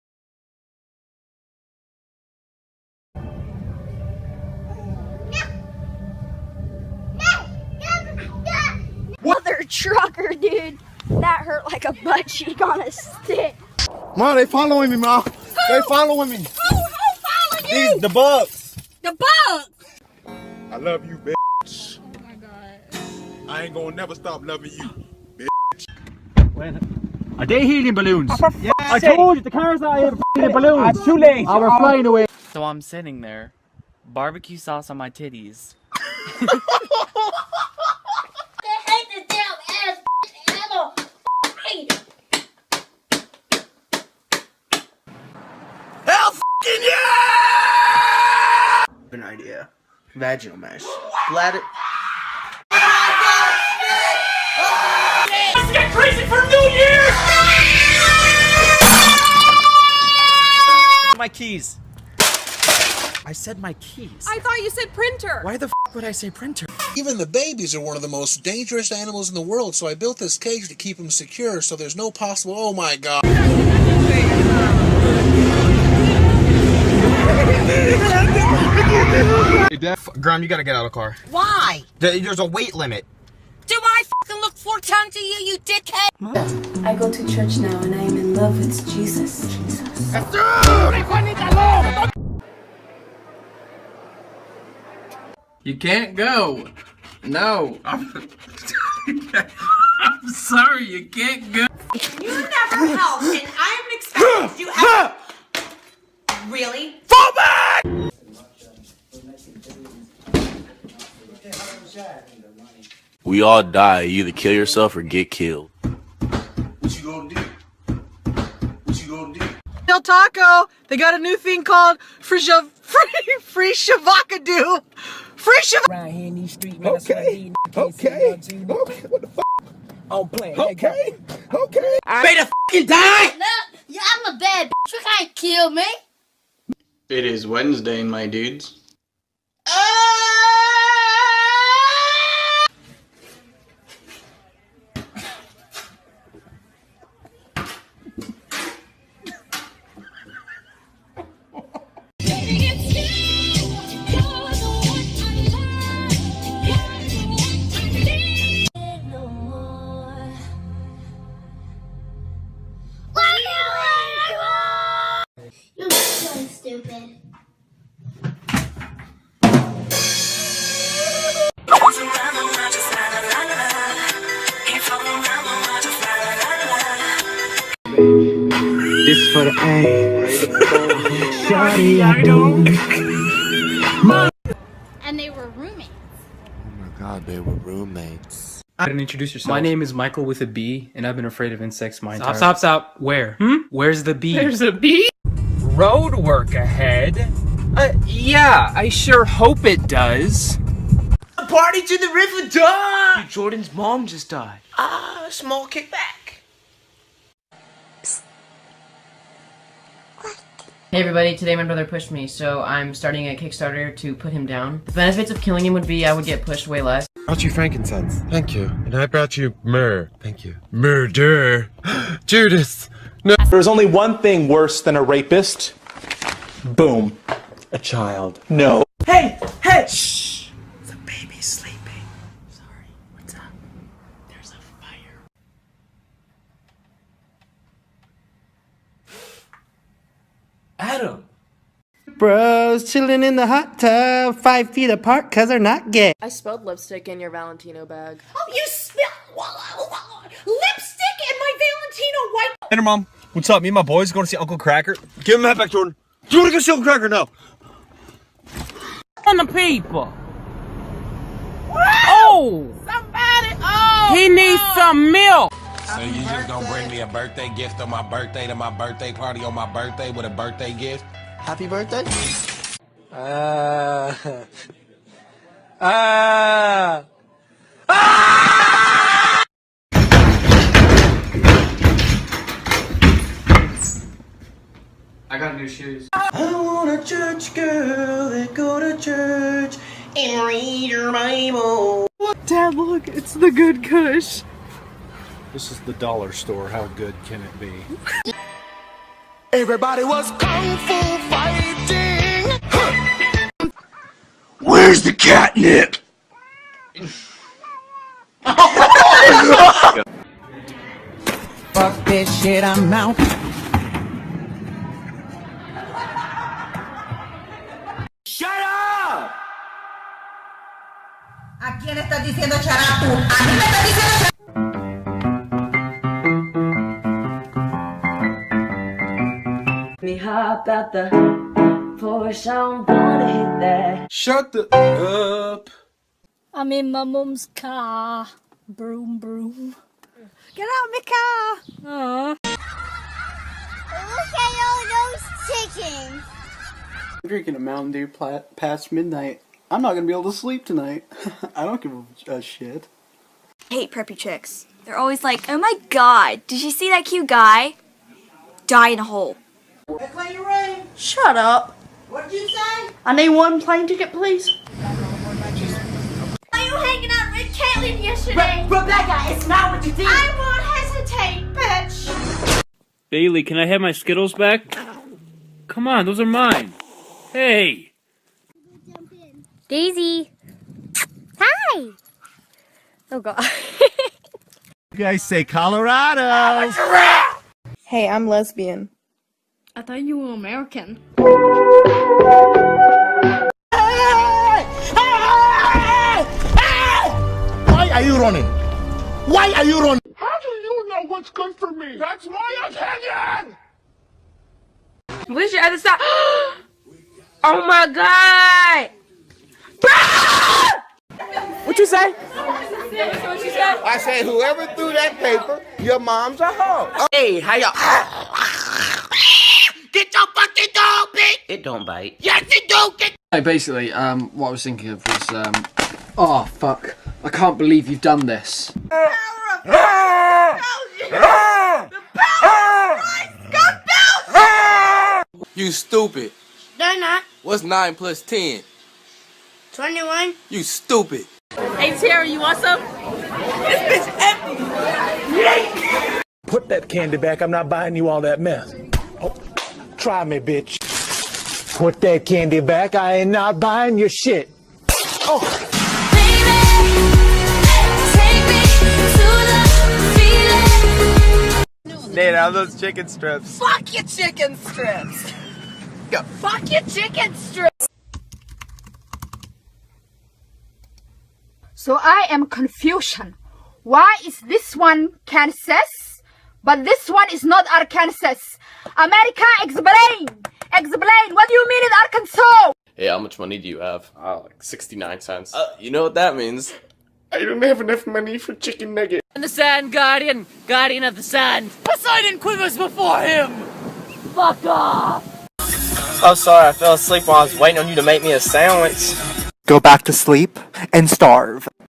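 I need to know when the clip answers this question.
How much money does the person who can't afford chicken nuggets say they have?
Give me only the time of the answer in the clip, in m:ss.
8:04.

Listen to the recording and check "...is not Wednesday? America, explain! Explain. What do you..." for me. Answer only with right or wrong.
wrong.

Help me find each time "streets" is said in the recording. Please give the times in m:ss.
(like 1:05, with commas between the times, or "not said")
2:06.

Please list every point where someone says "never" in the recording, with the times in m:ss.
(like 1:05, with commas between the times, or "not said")
0:23, 1:42.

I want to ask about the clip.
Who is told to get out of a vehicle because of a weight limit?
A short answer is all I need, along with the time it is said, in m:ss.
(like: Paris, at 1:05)
Graham, at 1:20.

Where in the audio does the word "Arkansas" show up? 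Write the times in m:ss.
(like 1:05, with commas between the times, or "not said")
7:57, 8:02.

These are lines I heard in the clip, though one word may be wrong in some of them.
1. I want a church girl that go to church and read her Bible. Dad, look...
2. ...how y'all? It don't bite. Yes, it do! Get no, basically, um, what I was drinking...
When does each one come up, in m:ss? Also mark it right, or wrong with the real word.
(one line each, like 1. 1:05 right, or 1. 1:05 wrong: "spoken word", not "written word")
1. 4:46 right
2. 6:57 wrong: "thinking", not "drinking".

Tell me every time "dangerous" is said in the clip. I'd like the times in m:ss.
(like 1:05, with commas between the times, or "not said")
1:08.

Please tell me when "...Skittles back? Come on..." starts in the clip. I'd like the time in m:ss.
6:13.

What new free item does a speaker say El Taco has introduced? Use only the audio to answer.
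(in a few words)
Shavacado.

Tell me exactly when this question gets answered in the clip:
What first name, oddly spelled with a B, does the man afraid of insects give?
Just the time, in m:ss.
3:09.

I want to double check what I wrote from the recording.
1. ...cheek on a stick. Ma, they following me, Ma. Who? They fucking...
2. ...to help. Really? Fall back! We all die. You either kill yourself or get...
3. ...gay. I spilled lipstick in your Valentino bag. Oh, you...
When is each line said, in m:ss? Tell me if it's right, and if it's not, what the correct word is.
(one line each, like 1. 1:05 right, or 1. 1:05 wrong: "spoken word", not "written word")
1. 0:12 wrong: "following", not "fucking"
2. 1:44 right
3. 4:05 right.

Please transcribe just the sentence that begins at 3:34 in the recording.
The benefits of killing him would be I would get pushed way less.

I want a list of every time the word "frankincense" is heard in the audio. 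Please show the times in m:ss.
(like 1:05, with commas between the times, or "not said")
3:37.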